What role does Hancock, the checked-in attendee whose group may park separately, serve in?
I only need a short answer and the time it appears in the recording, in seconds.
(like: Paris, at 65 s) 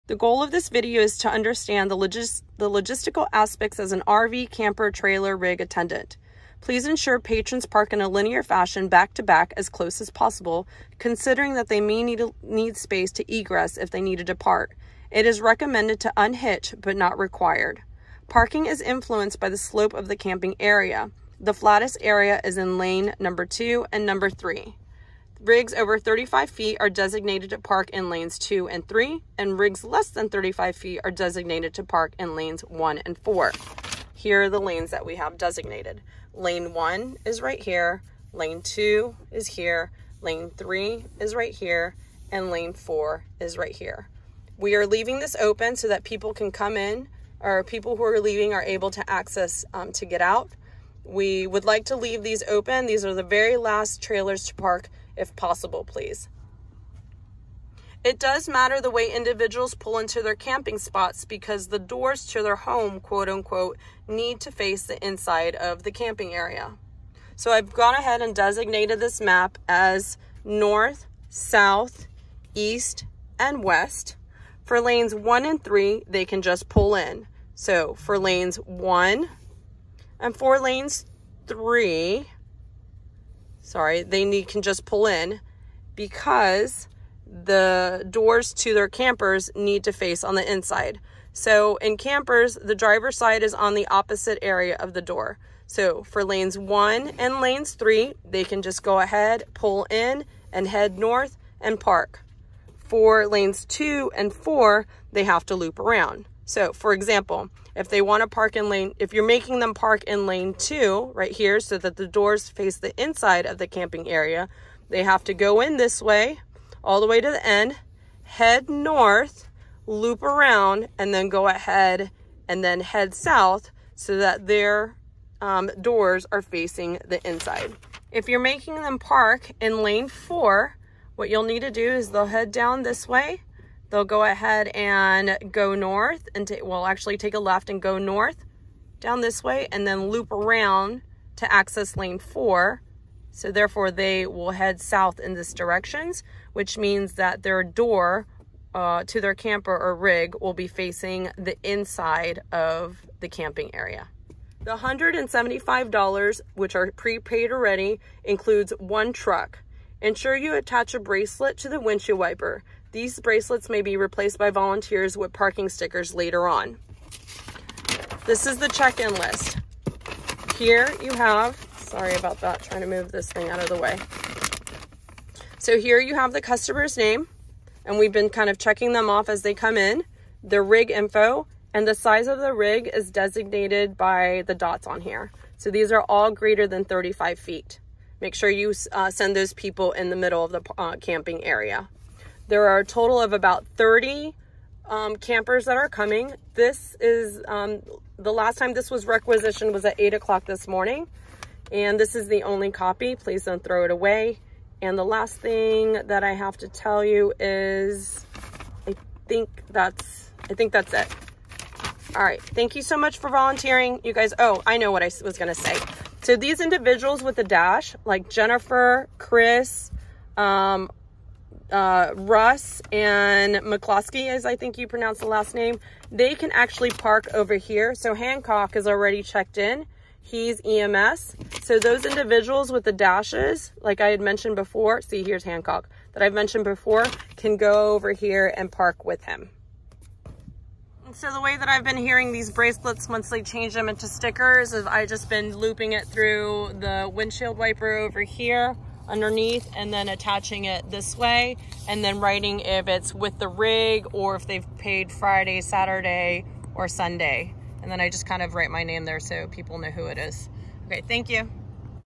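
EMS, at 230 s.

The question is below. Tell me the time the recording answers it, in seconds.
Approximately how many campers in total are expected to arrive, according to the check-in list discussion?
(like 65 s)
193 s.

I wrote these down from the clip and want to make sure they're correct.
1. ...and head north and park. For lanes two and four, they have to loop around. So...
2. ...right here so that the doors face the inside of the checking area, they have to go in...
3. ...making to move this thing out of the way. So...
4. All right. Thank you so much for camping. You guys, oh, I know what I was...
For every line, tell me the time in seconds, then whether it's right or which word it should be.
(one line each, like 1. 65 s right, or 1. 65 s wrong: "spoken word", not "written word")
1. 100 s right
2. 111 s wrong: "camping", not "checking"
3. 172 s wrong: "trying", not "making"
4. 212 s wrong: "volunteering", not "camping".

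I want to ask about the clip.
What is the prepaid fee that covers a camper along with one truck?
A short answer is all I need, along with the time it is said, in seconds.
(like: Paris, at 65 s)
$175, at 154 s.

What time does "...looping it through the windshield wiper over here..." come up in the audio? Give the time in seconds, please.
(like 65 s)
245 s.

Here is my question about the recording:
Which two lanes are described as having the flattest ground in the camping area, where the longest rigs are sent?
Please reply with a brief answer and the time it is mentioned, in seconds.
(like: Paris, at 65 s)
Lanes 2 and 3, at 22 s.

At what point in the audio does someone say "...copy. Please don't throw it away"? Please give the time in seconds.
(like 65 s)
202 s.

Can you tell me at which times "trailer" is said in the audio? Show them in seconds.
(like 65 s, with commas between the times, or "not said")
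4 s, 54 s.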